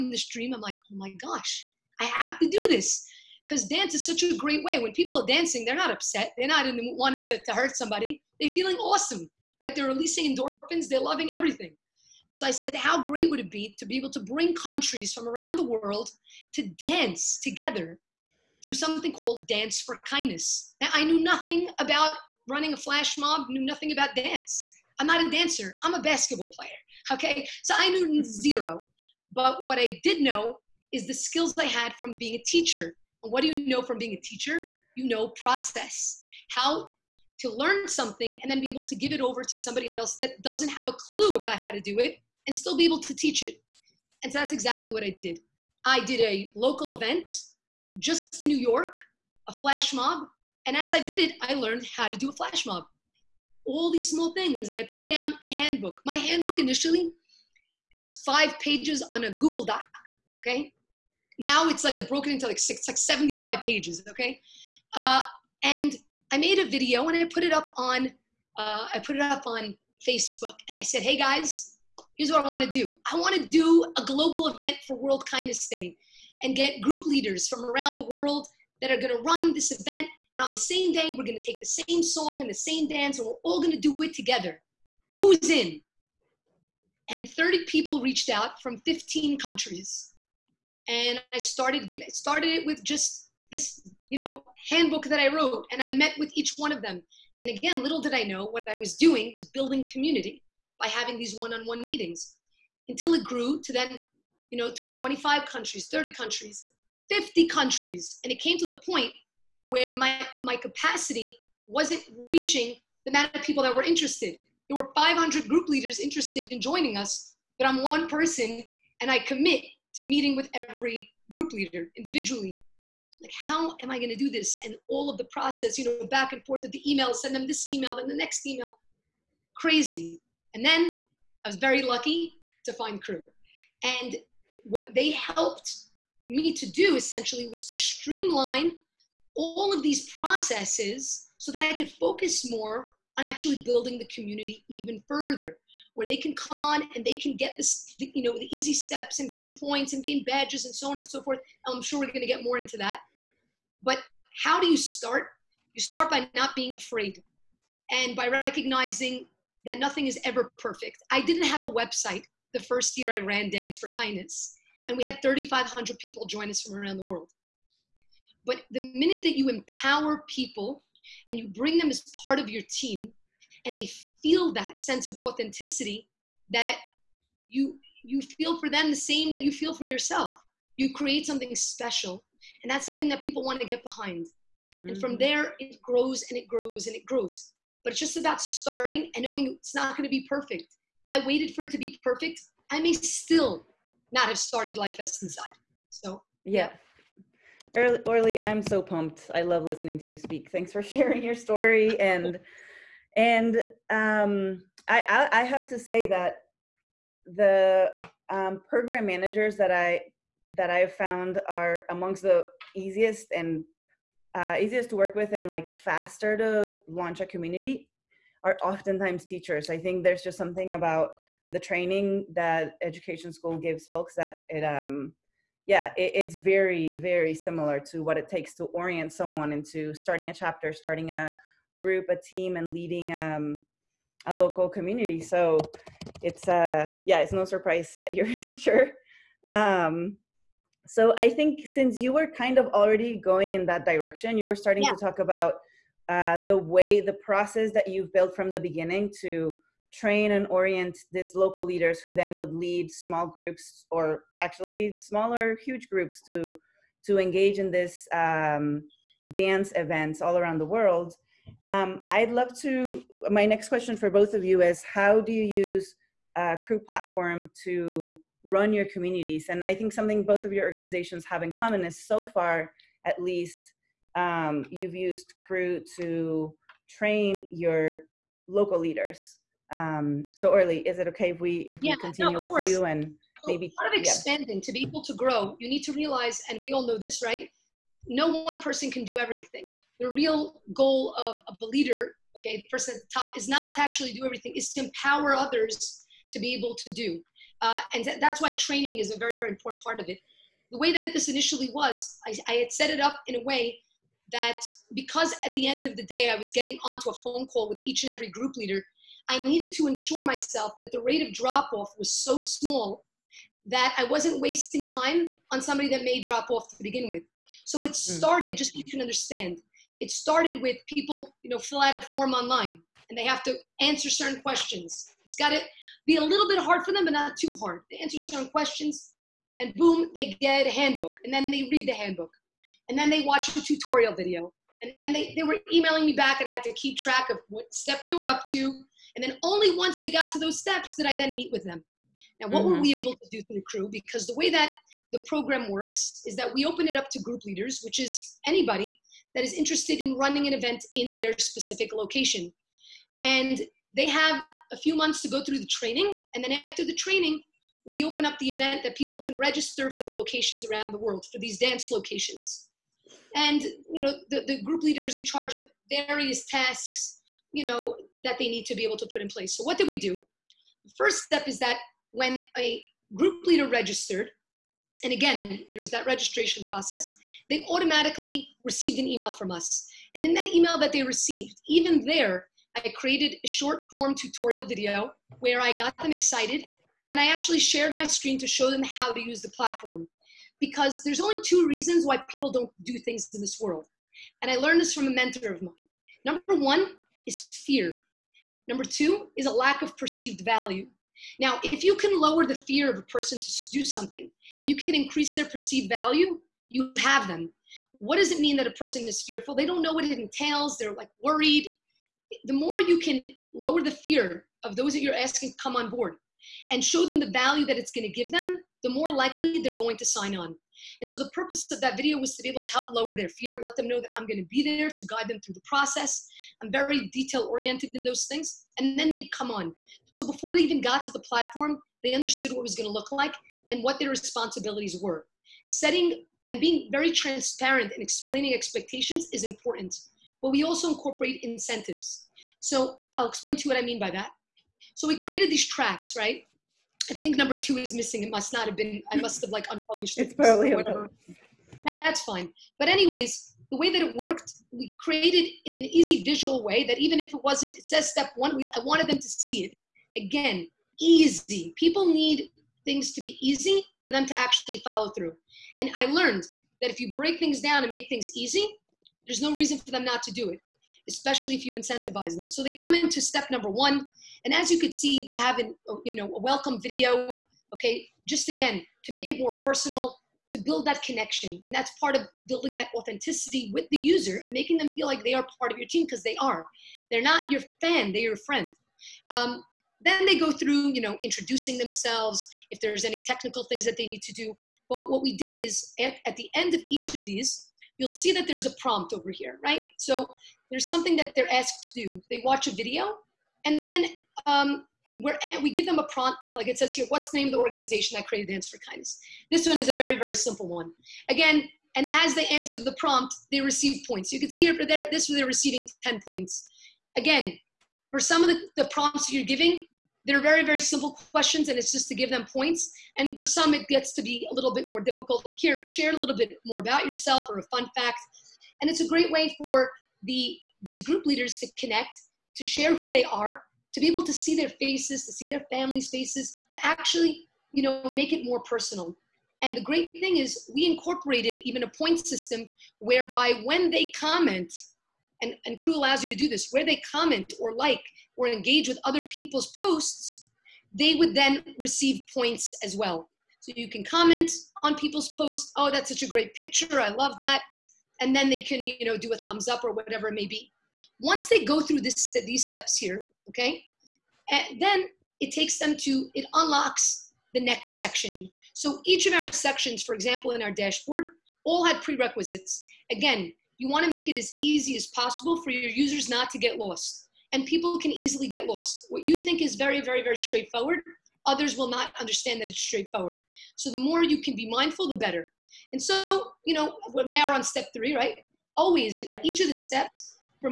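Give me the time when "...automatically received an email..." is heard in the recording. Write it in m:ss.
6:17.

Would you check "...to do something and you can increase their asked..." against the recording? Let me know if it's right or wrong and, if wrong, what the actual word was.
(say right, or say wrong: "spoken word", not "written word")
wrong: "perceived", not "asked".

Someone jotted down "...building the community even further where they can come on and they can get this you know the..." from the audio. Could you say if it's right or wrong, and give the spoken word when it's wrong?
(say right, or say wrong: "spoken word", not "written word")
right.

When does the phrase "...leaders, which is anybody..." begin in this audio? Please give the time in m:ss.
5:47.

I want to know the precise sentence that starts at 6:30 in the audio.
Because there's only two reasons why people don't do things in this world.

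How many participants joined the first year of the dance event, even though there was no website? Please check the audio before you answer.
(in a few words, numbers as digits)
3,500.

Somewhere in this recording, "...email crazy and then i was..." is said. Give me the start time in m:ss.
2:08.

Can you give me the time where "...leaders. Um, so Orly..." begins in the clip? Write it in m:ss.
4:38.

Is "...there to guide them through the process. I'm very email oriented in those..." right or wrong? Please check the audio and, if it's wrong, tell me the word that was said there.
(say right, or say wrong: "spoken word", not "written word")
wrong: "detail", not "email".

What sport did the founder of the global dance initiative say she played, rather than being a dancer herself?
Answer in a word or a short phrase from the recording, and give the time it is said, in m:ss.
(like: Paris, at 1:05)
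Basketball, at 0:26.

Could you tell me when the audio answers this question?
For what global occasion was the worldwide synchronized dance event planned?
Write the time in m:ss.
1:14.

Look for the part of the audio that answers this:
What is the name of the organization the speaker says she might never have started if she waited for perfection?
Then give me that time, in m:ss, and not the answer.
3:14.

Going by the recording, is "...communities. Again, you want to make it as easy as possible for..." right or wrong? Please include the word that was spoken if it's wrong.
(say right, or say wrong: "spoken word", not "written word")
wrong: "prerequisites", not "communities".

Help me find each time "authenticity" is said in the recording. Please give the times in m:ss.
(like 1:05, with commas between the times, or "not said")
2:55, 8:02.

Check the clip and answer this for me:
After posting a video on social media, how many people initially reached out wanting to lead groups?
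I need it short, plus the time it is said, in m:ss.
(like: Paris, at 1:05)
30, at 1:27.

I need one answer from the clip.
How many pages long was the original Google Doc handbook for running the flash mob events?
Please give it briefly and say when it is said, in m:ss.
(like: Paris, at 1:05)
5, at 0:58.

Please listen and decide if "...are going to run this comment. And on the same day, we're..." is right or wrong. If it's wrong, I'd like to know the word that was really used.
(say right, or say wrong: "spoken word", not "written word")
wrong: "event", not "comment".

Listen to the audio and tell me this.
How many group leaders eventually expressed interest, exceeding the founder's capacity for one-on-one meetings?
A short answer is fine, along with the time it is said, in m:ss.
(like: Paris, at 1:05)
500, at 1:54.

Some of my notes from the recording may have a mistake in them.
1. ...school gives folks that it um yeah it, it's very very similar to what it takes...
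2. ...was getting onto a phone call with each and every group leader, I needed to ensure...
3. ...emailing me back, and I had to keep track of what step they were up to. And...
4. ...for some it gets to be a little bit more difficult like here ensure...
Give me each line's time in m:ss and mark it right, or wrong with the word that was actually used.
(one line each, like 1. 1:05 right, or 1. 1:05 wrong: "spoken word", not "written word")
1. 3:43 right
2. 5:06 right
3. 5:35 right
4. 8:43 wrong: "share", not "ensure".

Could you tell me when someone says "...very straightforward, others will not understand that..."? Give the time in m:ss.
9:40.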